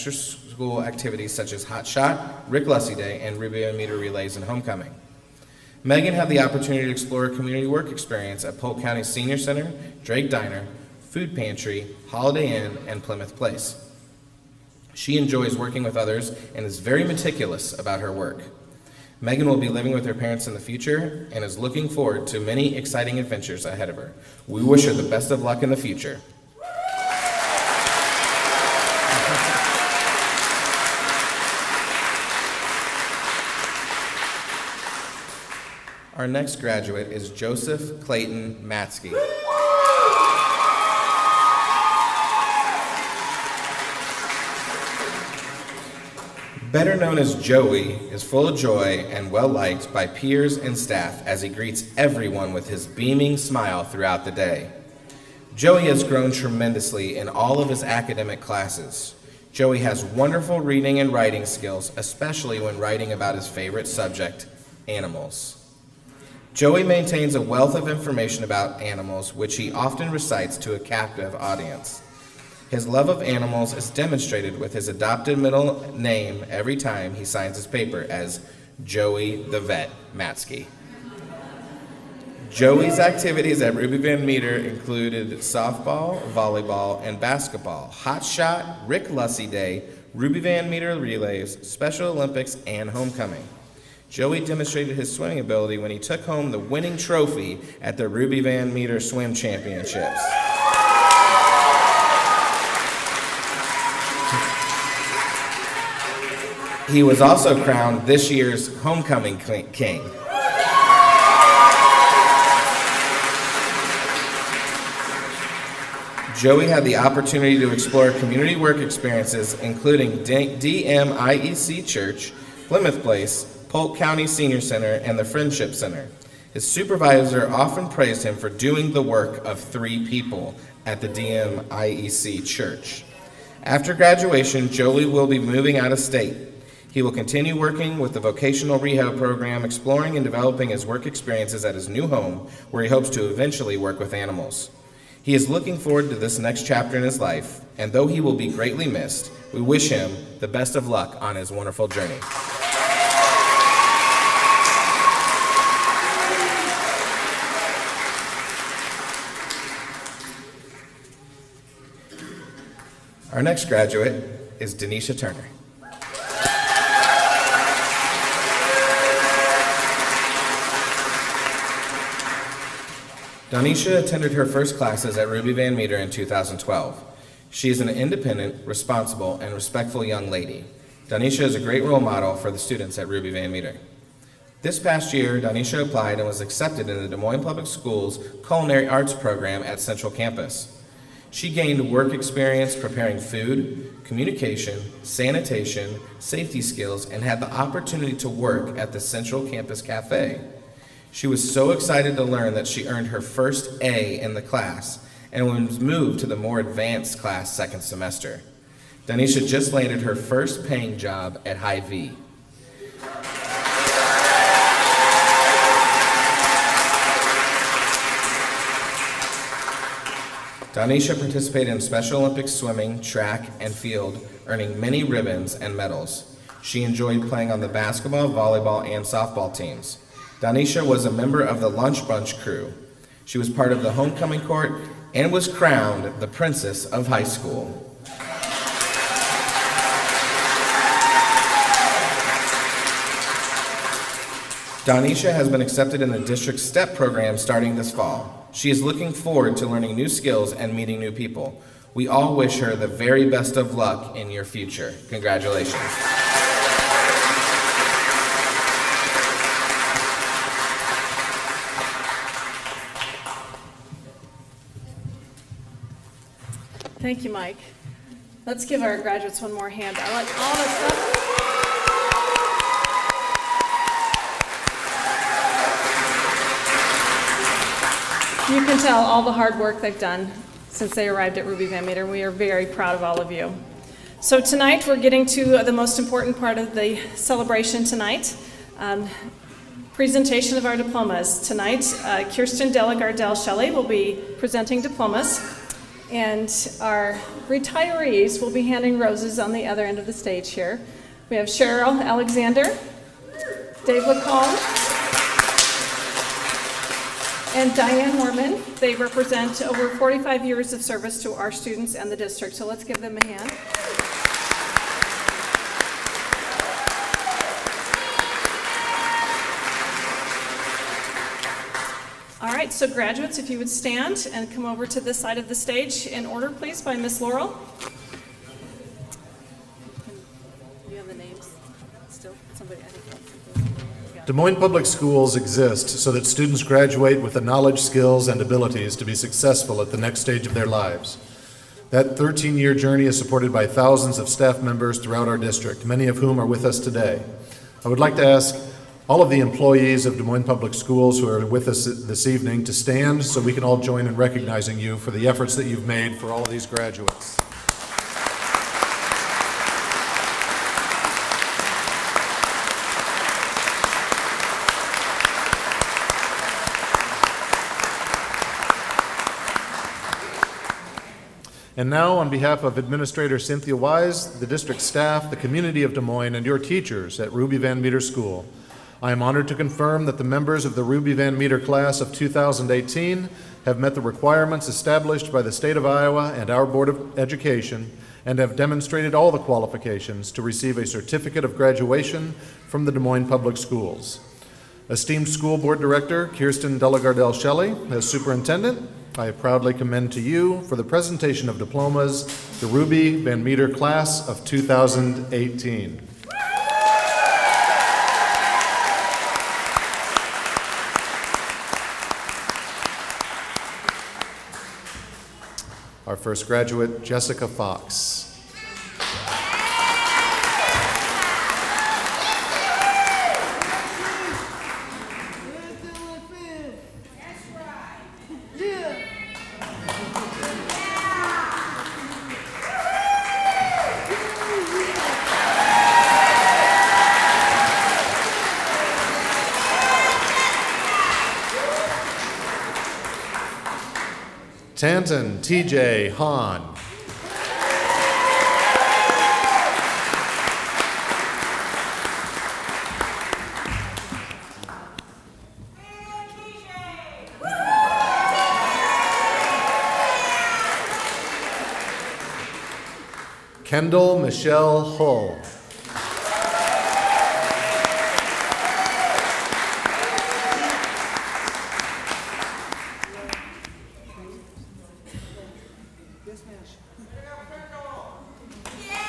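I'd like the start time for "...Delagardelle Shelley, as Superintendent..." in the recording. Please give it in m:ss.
6:36.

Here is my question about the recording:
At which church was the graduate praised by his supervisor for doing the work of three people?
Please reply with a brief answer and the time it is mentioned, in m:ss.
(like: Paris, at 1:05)
DMIEC Church, at 2:11.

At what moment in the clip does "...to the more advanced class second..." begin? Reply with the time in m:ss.
3:26.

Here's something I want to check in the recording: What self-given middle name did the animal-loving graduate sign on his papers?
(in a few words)
the Vet.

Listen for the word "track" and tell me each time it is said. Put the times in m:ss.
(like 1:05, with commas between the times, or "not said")
3:43.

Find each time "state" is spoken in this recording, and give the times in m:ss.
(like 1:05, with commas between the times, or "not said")
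2:15, 6:25.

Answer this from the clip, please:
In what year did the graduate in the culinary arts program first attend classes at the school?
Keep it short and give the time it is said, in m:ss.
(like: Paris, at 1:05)
2012, at 2:56.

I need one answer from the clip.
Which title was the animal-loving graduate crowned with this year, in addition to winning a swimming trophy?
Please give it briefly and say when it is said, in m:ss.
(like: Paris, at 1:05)
Homecoming King, at 1:48.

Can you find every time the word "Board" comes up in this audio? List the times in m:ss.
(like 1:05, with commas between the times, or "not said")
6:26, 6:35.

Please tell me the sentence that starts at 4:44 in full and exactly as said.
So tonight we're getting to the most important part of the celebration tonight.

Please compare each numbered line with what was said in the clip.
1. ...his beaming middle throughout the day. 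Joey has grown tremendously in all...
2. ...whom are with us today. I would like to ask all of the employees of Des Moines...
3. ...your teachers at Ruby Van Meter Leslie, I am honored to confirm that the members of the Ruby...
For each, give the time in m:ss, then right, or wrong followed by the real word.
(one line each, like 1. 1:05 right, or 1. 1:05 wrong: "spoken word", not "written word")
1. 0:52 wrong: "smile", not "middle"
2. 5:46 right
3. 6:16 wrong: "School", not "Leslie".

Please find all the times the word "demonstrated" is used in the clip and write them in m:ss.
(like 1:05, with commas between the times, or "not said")
1:13, 1:34, 6:28.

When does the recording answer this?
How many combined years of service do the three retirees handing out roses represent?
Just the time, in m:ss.
5:09.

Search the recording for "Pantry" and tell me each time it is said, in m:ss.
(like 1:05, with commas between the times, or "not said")
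0:11.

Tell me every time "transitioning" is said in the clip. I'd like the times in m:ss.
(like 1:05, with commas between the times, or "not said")
not said.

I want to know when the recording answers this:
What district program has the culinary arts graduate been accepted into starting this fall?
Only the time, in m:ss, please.
4:06.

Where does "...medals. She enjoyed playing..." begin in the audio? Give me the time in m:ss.
3:45.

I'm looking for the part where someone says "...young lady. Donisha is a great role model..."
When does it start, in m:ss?
3:00.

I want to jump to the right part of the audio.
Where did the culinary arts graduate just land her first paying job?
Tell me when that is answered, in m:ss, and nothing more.
3:31.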